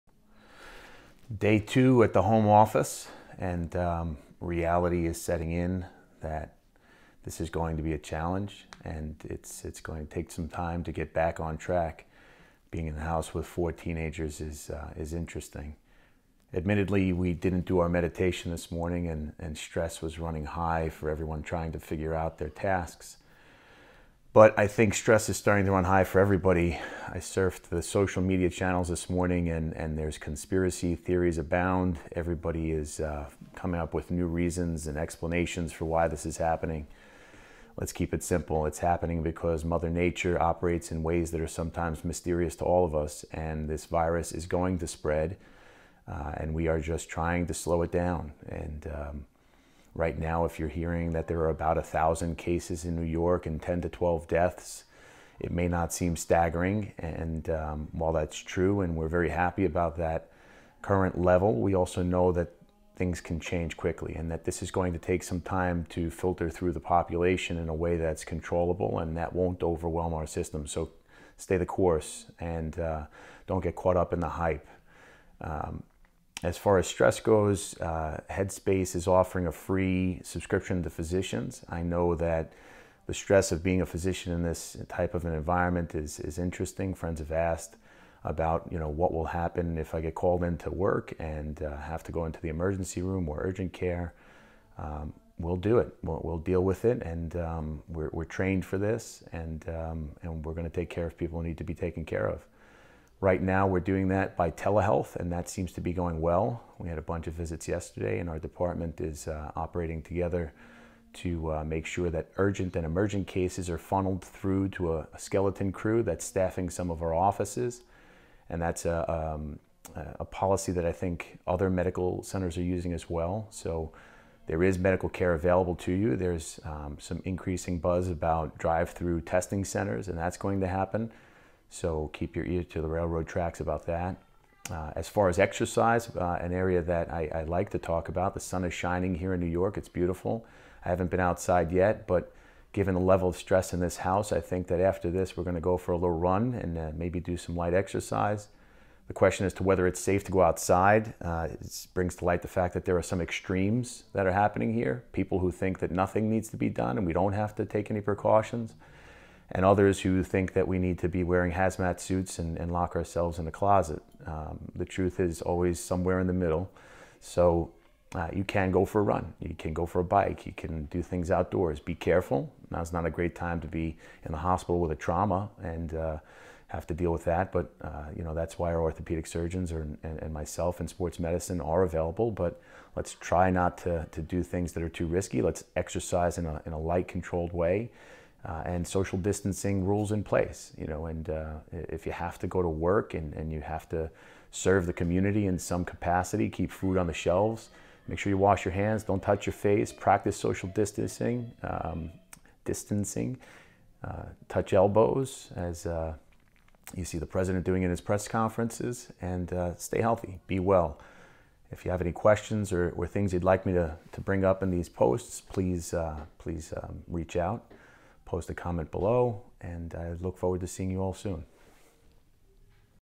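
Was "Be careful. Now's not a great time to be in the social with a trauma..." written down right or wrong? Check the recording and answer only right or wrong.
wrong.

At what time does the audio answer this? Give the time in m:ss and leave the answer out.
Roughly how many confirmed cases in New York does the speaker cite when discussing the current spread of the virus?
0:51.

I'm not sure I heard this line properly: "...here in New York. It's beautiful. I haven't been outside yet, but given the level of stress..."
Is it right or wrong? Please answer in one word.
right.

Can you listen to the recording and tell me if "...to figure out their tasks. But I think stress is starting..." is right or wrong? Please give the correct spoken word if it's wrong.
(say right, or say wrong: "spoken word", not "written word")
right.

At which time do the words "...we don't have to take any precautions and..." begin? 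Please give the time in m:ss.
2:37.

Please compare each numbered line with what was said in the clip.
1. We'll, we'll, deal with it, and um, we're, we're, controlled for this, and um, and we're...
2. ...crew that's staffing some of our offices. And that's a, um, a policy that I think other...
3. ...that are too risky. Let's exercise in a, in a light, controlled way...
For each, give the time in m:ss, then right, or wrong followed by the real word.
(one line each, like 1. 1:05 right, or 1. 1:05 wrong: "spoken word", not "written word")
1. 1:36 wrong: "trained", not "controlled"
2. 1:55 right
3. 3:04 right.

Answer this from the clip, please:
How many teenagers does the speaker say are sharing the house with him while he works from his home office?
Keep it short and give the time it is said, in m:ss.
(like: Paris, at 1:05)
4, at 0:13.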